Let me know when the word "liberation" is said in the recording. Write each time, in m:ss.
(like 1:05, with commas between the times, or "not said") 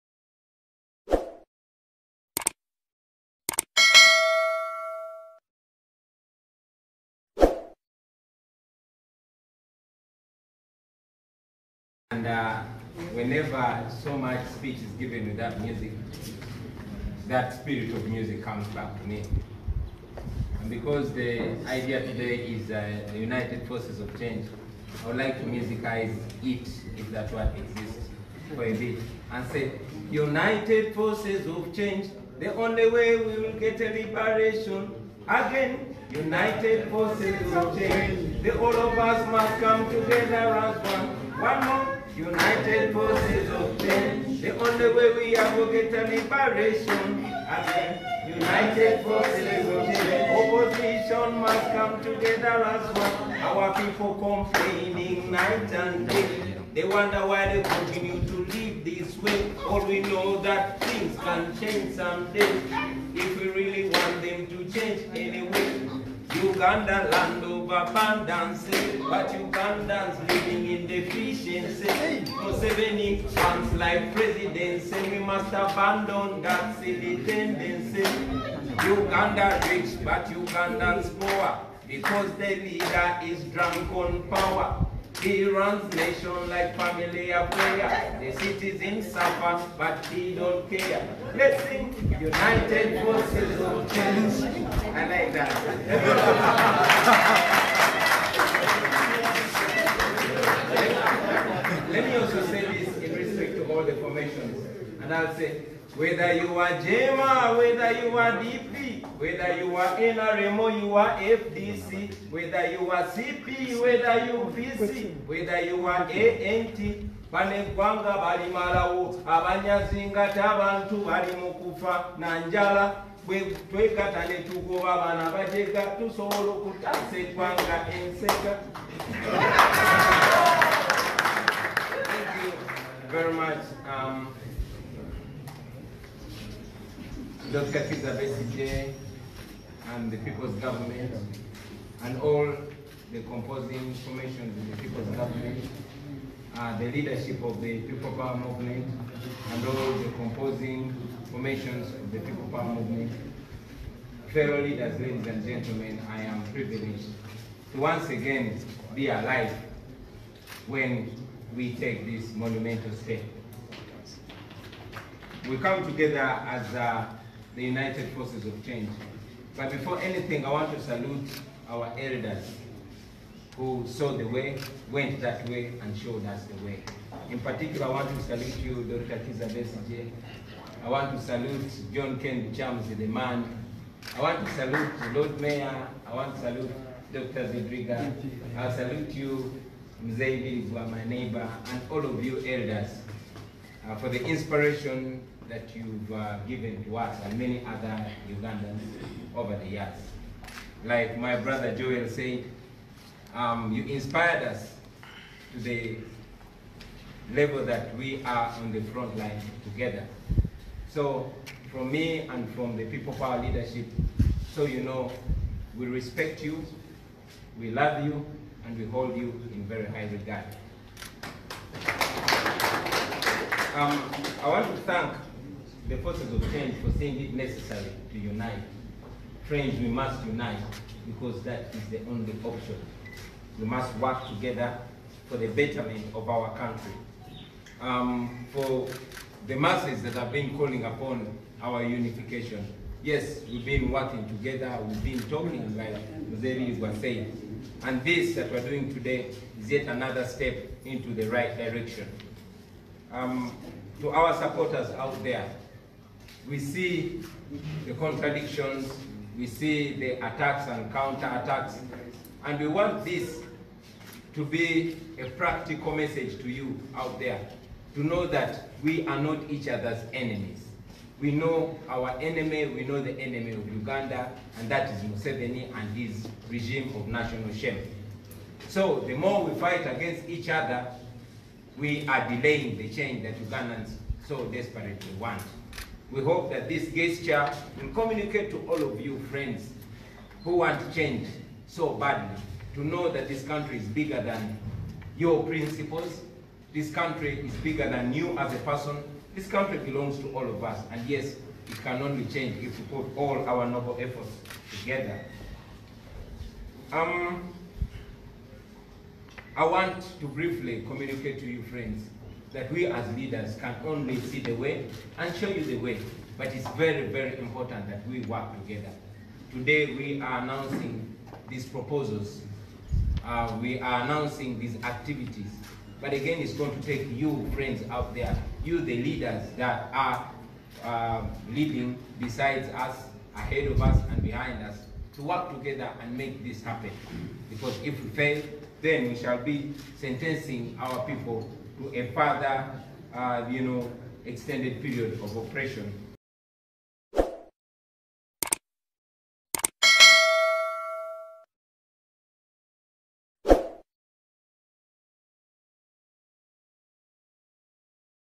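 0:33, 0:46.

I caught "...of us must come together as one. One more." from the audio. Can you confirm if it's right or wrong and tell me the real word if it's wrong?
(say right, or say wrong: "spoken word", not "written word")
right.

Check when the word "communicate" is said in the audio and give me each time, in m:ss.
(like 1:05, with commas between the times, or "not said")
4:47, 5:10.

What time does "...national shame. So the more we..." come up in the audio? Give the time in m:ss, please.
4:37.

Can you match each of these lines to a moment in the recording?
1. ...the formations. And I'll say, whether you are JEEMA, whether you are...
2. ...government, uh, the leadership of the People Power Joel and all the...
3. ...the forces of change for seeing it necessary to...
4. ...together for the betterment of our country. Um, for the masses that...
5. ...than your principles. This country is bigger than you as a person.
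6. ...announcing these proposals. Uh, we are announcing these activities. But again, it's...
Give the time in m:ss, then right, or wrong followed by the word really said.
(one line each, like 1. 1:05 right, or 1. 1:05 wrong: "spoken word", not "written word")
1. 1:43 right
2. 2:25 wrong: "Movement", not "Joel"
3. 3:45 right
4. 3:54 right
5. 4:54 right
6. 5:20 right.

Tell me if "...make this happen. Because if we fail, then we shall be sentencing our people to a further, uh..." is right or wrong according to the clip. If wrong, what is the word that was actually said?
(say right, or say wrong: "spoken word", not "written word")
right.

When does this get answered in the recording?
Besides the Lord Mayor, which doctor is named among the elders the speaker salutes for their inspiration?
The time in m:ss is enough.
3:07.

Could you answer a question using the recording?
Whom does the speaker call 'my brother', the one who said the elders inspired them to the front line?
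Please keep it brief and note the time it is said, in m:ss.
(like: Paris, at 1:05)
Joel, at 3:21.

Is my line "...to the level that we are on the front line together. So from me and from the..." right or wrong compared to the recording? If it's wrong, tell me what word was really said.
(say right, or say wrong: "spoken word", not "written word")
right.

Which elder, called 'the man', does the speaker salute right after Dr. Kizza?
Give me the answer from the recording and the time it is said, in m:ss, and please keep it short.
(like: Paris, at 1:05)
John Ken Chams, at 3:01.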